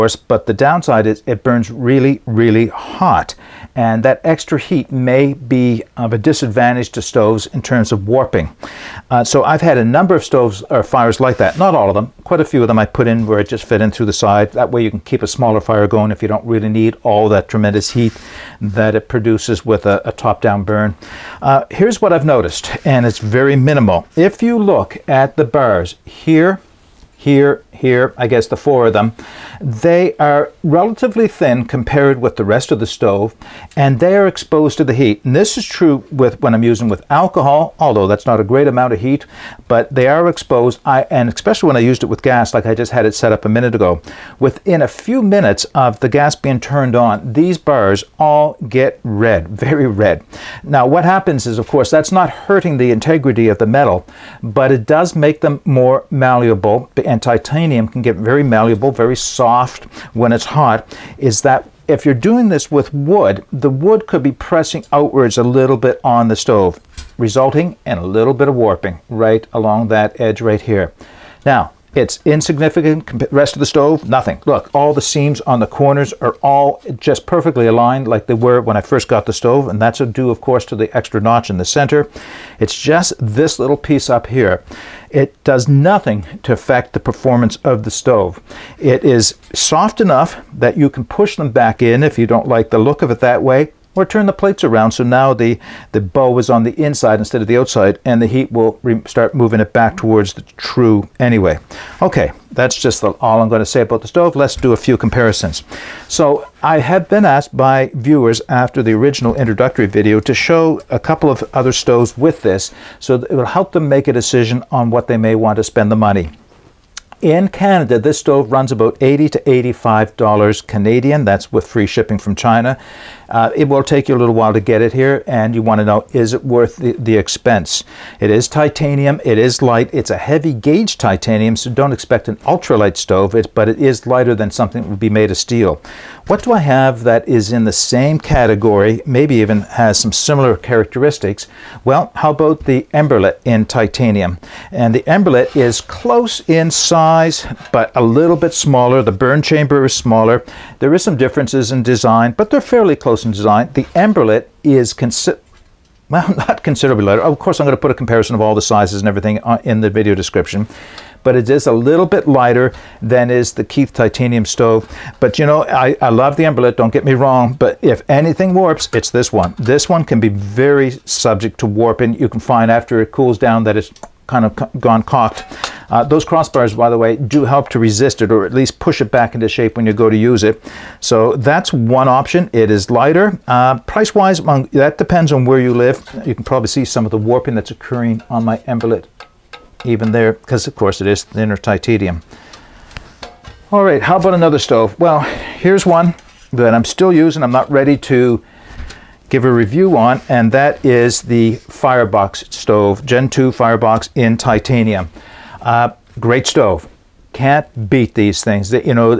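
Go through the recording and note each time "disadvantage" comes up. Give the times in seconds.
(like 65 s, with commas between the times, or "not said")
6 s.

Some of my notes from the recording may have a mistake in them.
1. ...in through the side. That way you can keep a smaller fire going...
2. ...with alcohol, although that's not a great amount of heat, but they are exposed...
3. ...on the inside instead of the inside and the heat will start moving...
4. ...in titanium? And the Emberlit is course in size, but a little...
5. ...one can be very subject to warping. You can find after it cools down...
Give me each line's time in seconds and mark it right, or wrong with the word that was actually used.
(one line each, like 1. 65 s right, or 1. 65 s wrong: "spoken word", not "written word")
1. 13 s right
2. 36 s right
3. 96 s wrong: "outside", not "inside"
4. 143 s wrong: "close", not "course"
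5. 169 s right.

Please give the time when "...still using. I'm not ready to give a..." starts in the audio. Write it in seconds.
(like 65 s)
196 s.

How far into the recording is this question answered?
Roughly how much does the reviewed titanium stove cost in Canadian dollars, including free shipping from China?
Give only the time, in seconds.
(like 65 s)
118 s.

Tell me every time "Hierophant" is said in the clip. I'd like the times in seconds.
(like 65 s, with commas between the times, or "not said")
not said.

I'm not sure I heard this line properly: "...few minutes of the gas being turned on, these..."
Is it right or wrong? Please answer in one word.
right.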